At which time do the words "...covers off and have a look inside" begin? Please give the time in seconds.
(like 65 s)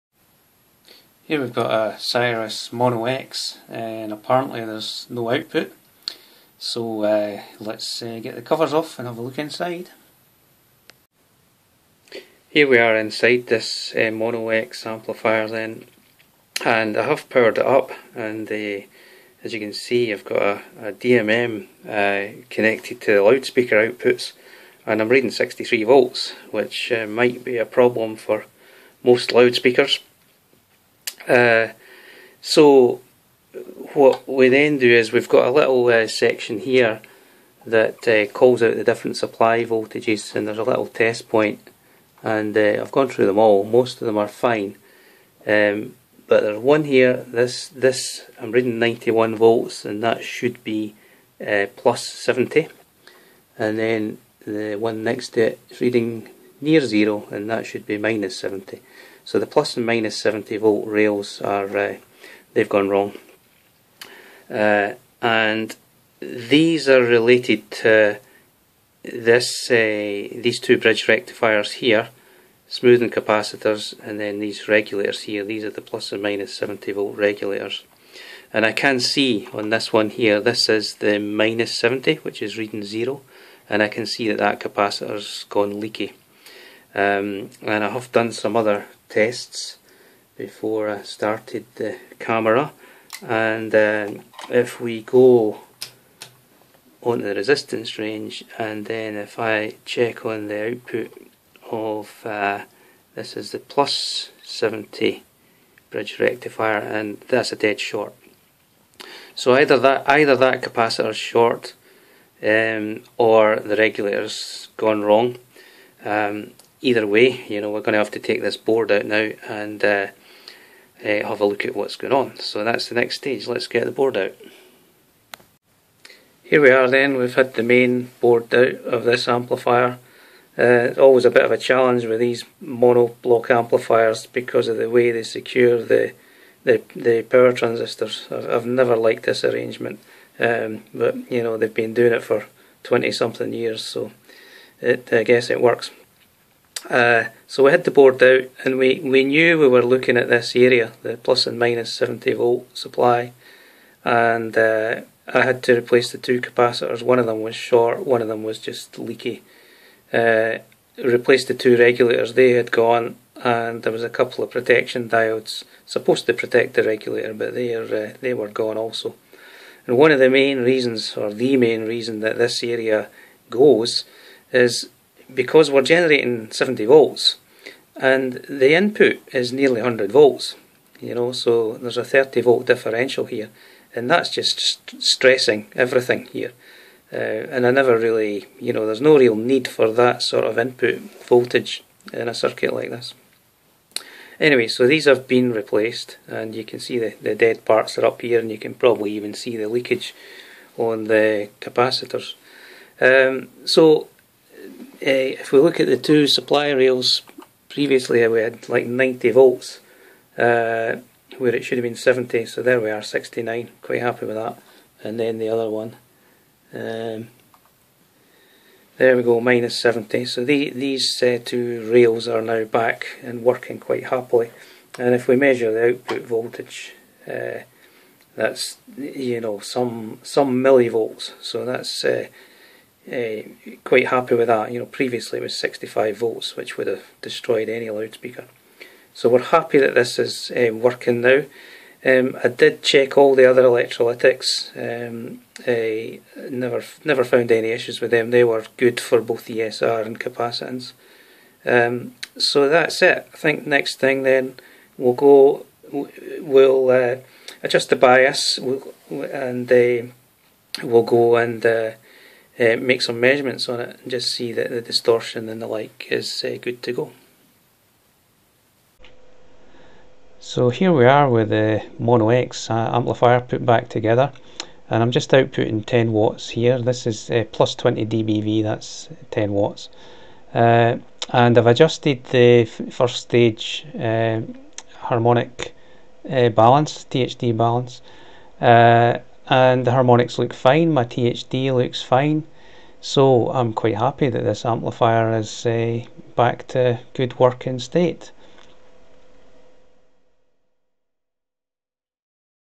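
8 s.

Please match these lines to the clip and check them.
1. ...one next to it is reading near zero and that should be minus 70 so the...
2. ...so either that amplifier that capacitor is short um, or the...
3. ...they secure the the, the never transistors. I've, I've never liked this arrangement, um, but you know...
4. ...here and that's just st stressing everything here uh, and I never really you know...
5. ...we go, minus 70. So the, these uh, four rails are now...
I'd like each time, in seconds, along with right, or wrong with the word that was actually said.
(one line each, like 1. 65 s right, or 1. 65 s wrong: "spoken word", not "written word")
1. 54 s right
2. 109 s wrong: "either", not "amplifier"
3. 135 s wrong: "power", not "never"
4. 183 s right
5. 219 s wrong: "two", not "four".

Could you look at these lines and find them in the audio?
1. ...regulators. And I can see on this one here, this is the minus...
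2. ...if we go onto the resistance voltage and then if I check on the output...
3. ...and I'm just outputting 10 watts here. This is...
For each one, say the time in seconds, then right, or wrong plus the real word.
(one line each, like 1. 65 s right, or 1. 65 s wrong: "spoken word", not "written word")
1. 77 s right
2. 94 s wrong: "range", not "voltage"
3. 274 s right.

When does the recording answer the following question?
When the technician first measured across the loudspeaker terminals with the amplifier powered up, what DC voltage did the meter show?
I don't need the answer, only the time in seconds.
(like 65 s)
25 s.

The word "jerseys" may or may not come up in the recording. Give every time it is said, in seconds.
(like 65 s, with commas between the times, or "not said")
not said.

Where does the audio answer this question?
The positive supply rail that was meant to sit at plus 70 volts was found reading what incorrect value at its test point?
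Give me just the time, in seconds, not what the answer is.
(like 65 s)
48 s.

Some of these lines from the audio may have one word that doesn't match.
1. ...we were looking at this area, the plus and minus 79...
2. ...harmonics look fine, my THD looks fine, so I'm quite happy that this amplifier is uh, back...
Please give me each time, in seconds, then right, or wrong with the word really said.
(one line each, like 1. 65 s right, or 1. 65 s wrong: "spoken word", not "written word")
1. 149 s wrong: "70", not "79"
2. 289 s right.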